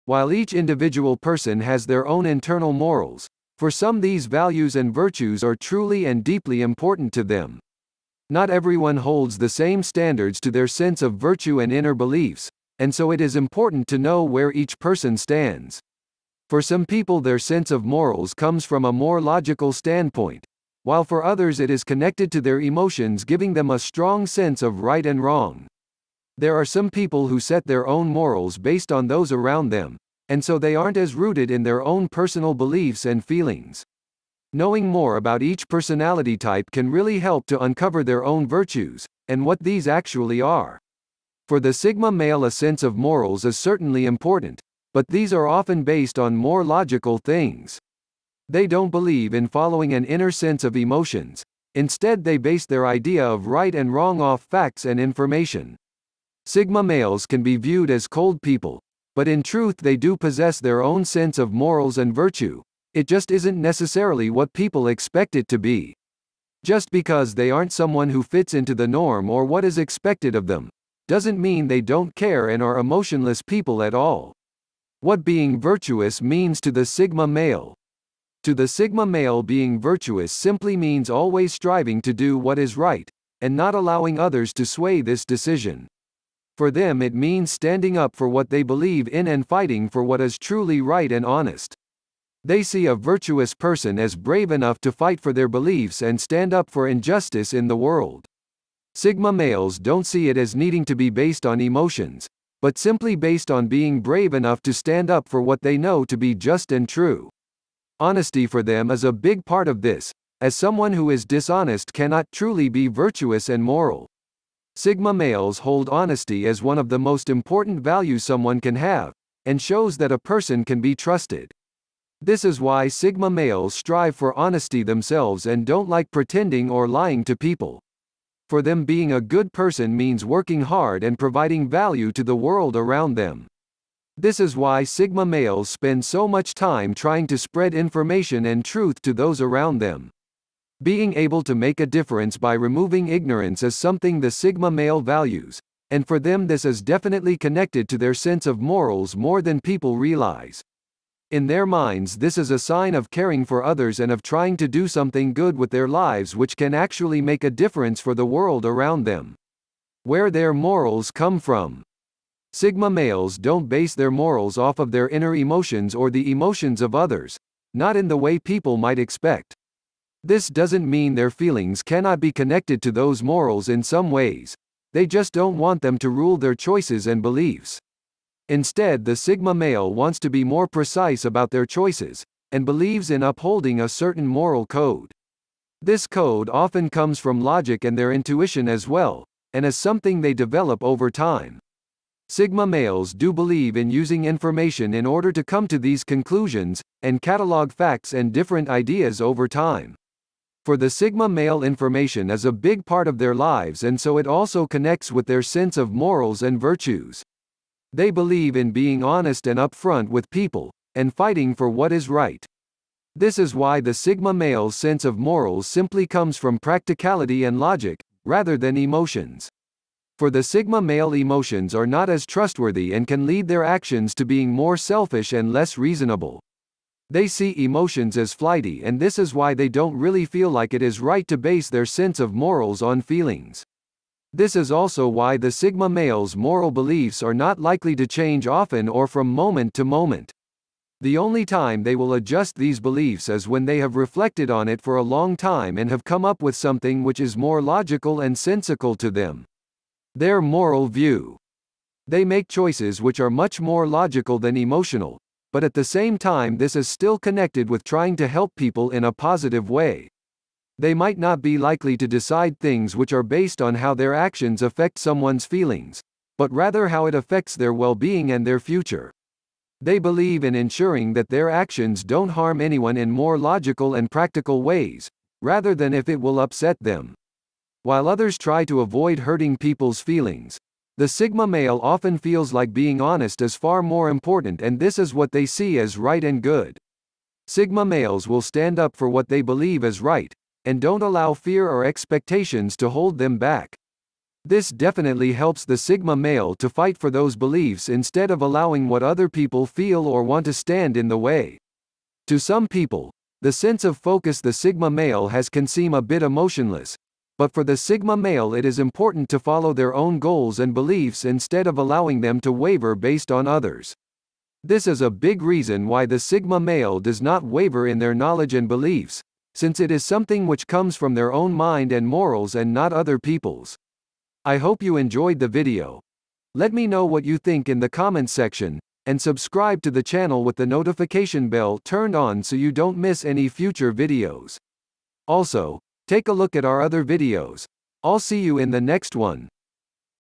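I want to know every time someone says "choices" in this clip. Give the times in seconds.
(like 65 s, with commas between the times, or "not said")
176 s, 181 s, 252 s.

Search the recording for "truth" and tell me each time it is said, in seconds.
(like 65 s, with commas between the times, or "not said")
59 s, 138 s.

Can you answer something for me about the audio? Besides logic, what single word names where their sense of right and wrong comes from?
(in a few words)
practicality.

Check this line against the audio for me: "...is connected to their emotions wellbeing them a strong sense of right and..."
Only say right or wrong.
wrong.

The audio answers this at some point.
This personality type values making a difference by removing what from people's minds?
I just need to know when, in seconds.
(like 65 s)
143 s.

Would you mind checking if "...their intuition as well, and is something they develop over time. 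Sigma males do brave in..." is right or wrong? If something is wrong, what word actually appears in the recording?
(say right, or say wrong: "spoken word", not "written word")
wrong: "believe", not "brave".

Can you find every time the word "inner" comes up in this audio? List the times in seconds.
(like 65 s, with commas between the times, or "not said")
11 s, 50 s, 165 s.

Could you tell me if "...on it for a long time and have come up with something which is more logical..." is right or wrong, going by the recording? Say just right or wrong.
right.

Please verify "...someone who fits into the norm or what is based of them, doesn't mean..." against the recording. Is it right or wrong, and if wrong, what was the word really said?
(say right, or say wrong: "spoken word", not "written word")
wrong: "expected", not "based".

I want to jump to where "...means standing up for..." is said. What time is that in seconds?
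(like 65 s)
87 s.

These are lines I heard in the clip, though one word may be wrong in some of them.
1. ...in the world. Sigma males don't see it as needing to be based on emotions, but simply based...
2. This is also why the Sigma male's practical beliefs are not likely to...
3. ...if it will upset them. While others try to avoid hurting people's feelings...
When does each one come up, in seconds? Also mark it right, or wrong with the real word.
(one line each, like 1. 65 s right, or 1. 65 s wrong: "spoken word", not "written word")
1. 97 s right
2. 234 s wrong: "moral", not "practical"
3. 275 s right.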